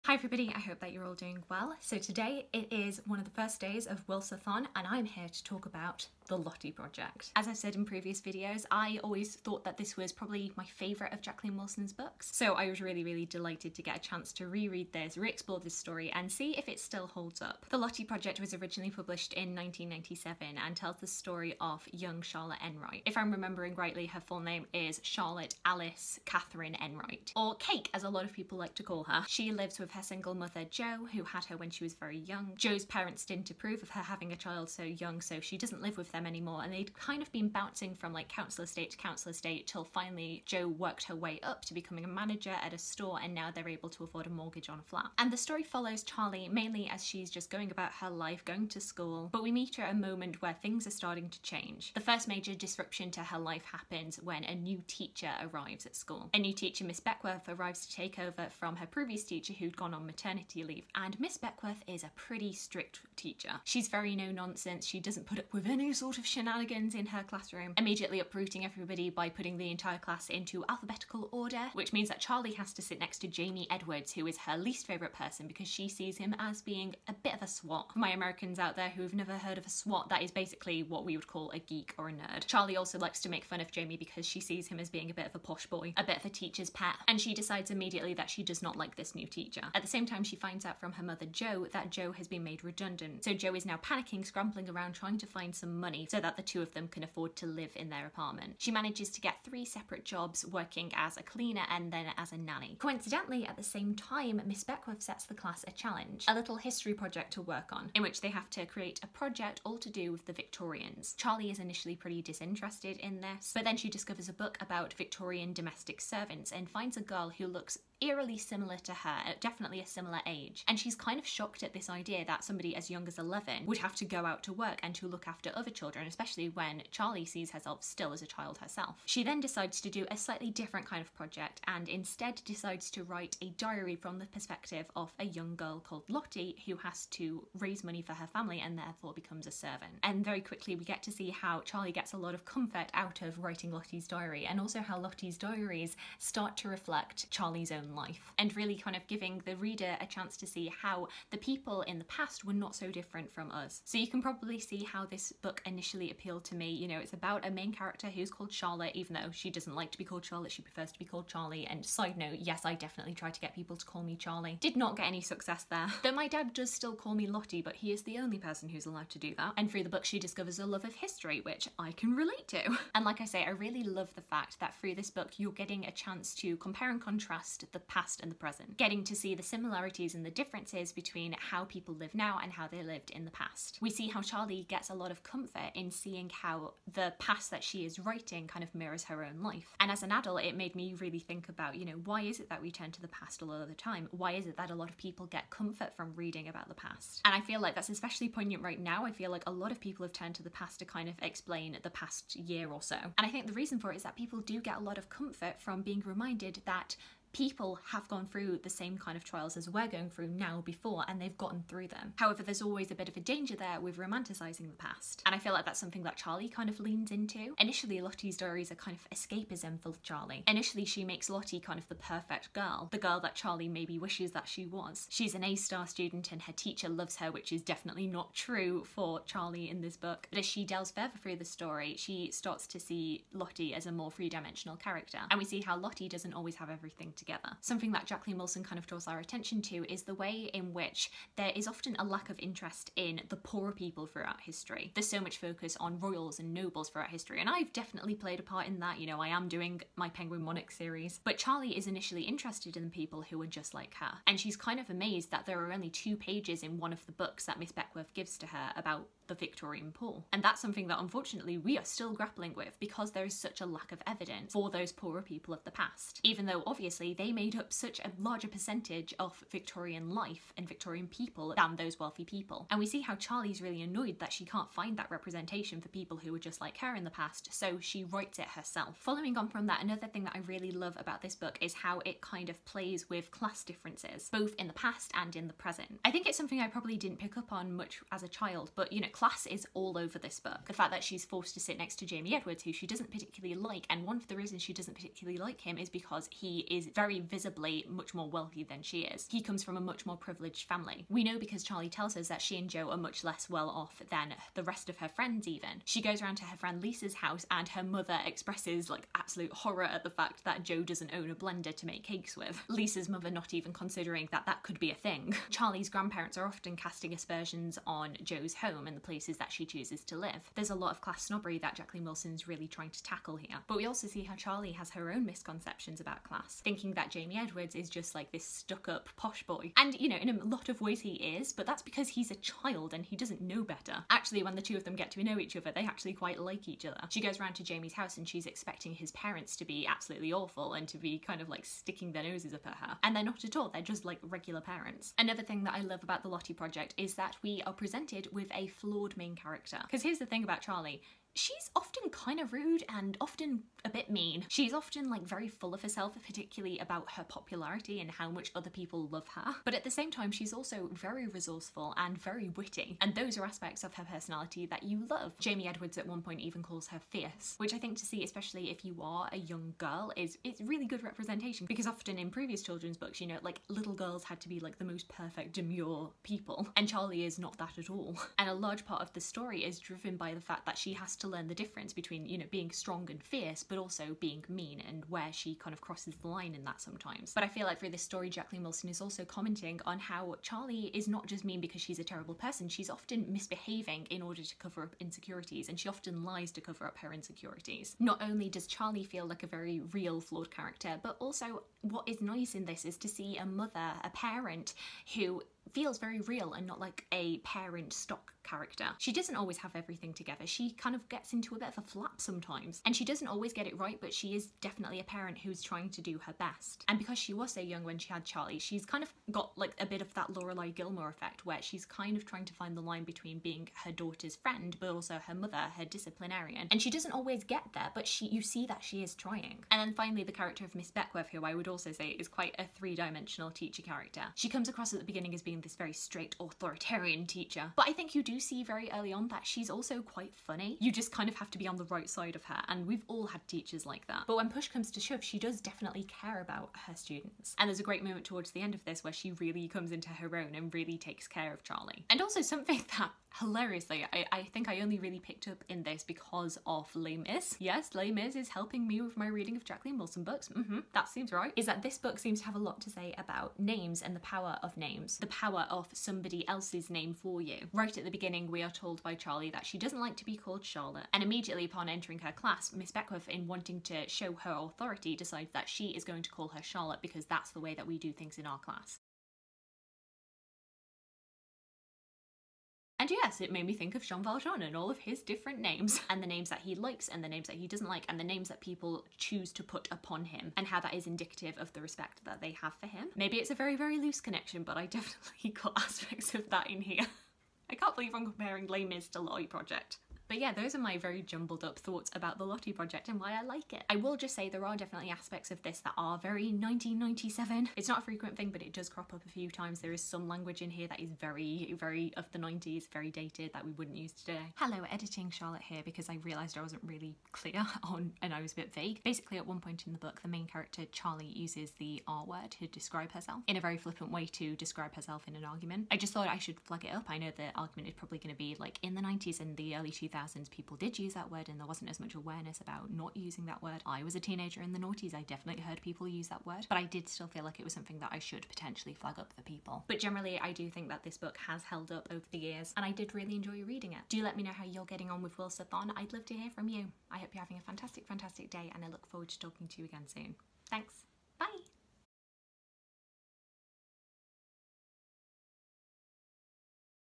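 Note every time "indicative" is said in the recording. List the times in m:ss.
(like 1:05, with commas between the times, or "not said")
8:11.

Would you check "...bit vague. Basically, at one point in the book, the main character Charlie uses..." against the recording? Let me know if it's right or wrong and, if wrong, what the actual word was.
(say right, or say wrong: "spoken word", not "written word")
right.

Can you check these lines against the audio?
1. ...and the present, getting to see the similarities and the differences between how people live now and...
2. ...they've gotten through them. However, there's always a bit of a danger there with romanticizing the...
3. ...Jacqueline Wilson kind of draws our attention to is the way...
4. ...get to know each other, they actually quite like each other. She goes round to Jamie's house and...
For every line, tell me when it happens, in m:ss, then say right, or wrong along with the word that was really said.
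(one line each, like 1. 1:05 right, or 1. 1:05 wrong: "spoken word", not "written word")
1. 2:58 right
2. 3:31 right
3. 3:58 right
4. 5:34 right.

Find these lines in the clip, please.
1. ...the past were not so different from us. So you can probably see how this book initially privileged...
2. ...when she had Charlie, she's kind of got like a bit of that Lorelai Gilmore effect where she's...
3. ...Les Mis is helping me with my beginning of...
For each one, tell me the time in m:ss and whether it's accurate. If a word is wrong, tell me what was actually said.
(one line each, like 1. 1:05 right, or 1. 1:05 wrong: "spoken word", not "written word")
1. 2:31 wrong: "appealed", not "privileged"
2. 6:57 right
3. 7:37 wrong: "reading", not "beginning".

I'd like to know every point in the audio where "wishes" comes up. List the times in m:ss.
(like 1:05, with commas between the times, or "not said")
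3:43.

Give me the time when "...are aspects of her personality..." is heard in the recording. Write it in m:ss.
6:03.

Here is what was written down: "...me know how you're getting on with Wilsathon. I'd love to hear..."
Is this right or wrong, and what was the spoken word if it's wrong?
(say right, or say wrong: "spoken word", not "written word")
right.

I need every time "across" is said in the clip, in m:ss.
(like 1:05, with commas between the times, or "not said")
7:14.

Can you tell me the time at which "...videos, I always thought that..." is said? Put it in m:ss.
0:08.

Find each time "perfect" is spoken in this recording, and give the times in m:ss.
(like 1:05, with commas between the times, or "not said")
3:41, 6:15.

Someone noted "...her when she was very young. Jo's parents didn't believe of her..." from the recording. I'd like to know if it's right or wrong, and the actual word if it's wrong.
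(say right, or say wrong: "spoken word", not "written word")
wrong: "approve", not "believe".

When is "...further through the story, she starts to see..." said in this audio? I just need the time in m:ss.
3:50.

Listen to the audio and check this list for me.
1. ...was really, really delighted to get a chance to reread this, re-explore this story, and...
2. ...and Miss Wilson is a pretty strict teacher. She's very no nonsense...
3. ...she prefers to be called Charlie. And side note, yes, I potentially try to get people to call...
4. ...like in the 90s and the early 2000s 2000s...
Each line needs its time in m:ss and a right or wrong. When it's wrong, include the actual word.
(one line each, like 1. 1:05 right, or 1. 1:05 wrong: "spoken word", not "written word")
1. 0:12 right
2. 1:00 wrong: "Beckworth", not "Wilson"
3. 2:40 wrong: "definitely", not "potentially"
4. 8:48 right.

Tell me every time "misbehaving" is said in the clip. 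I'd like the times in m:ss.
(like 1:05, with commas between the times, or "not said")
6:33.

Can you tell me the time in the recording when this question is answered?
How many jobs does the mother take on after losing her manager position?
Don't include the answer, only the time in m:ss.
1:39.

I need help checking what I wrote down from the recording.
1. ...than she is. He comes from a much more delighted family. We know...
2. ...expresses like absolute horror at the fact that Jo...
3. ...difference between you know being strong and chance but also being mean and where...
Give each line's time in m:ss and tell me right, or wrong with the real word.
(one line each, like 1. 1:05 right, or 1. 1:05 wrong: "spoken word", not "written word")
1. 4:58 wrong: "privileged", not "delighted"
2. 5:08 right
3. 6:21 wrong: "fierce", not "chance".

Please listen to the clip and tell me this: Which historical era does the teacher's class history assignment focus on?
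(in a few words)
The Victorians.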